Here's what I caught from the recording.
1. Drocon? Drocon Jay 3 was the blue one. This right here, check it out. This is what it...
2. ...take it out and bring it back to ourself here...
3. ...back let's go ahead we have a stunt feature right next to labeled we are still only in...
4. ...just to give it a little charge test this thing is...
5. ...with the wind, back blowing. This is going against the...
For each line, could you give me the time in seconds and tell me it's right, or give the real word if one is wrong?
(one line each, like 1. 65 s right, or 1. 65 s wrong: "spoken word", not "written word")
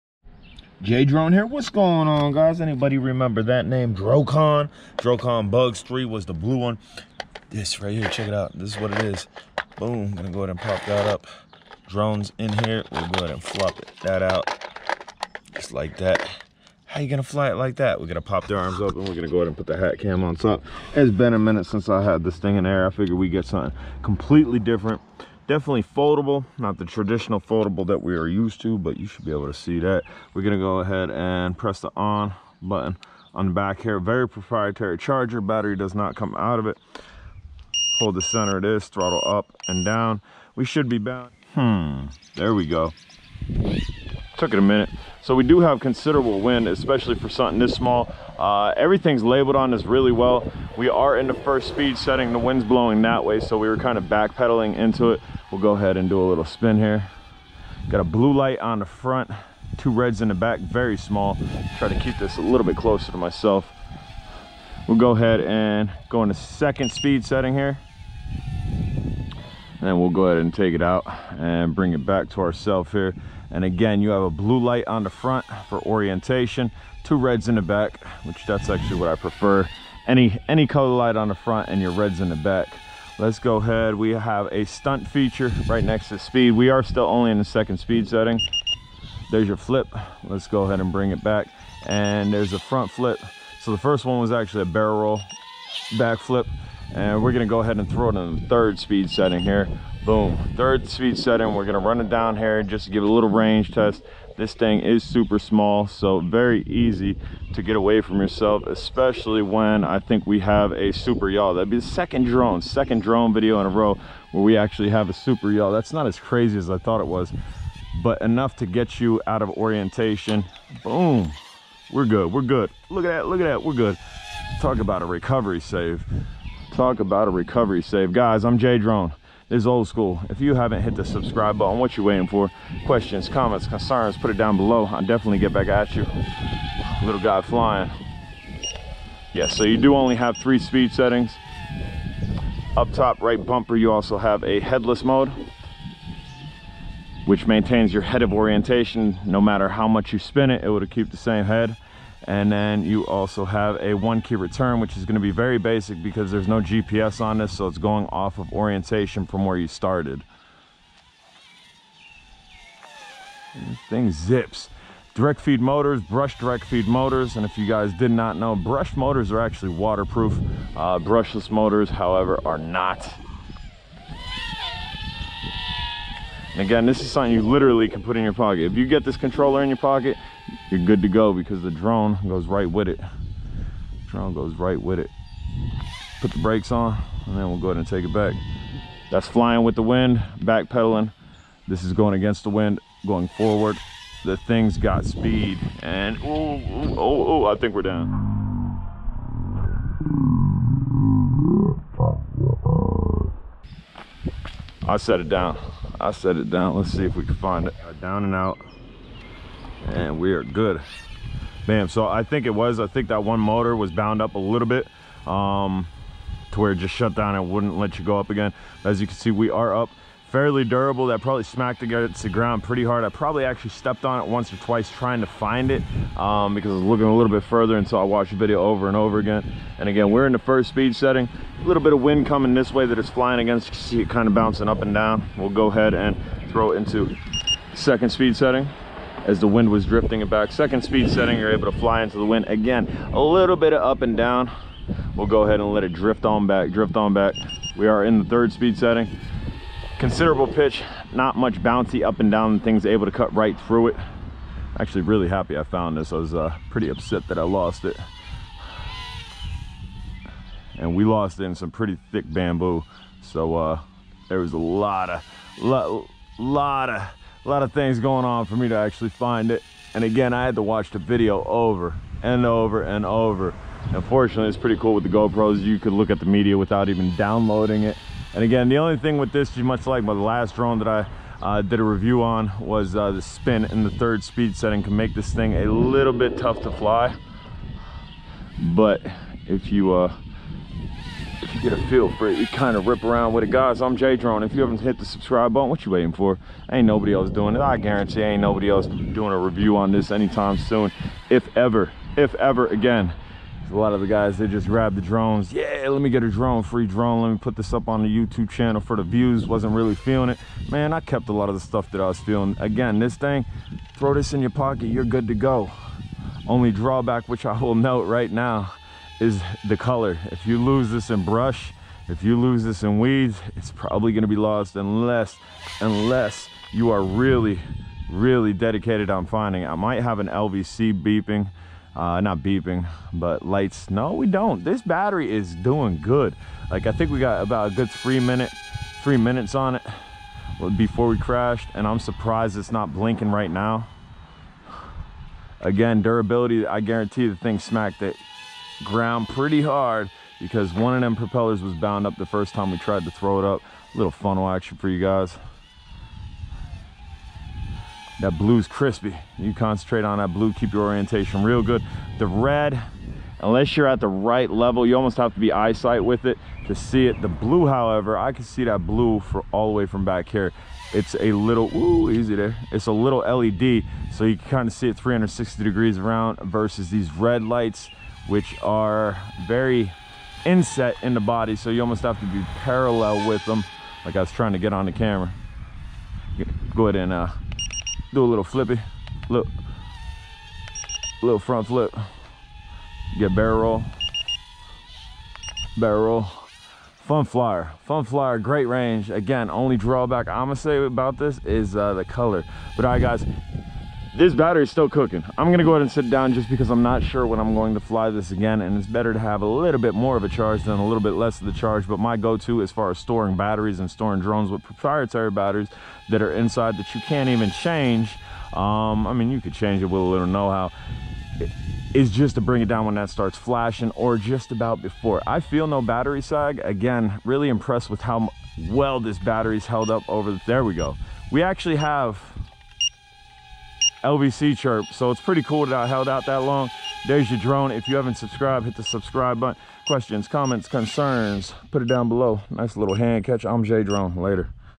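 1. 3 s wrong: "Bugs", not "Jay"
2. 70 s right
3. 82 s wrong: "speed", not "labeled"
4. 102 s wrong: "range", not "charge"
5. 189 s wrong: "pedaling", not "blowing".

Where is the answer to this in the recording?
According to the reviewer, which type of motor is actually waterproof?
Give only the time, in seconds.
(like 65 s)
168 s.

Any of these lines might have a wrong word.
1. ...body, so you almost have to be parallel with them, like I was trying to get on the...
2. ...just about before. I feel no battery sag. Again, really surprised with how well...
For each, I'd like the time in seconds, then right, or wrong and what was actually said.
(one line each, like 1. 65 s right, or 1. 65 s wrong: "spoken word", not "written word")
1. 381 s right
2. 424 s wrong: "impressed", not "surprised".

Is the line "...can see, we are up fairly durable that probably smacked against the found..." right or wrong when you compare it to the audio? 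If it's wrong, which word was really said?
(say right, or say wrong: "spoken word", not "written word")
wrong: "ground", not "found".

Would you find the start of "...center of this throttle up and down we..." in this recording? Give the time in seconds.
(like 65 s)
38 s.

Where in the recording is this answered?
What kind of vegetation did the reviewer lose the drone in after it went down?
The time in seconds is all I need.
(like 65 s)
261 s.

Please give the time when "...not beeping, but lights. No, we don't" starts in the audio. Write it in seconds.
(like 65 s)
332 s.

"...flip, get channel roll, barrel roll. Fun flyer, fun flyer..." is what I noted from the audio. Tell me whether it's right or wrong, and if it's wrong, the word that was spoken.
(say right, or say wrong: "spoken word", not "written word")
wrong: "barrel", not "channel".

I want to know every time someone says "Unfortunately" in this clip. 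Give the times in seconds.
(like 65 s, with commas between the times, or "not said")
273 s.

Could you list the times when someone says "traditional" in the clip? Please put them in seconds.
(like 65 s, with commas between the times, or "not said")
26 s.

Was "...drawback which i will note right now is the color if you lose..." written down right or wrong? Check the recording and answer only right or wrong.
right.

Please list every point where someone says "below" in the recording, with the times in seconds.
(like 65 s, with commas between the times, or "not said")
134 s, 442 s.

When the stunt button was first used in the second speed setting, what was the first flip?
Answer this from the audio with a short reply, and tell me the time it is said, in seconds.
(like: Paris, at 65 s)
Barrel roll back flip, at 94 s.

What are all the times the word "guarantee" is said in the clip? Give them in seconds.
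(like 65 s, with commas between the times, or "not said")
297 s, 346 s.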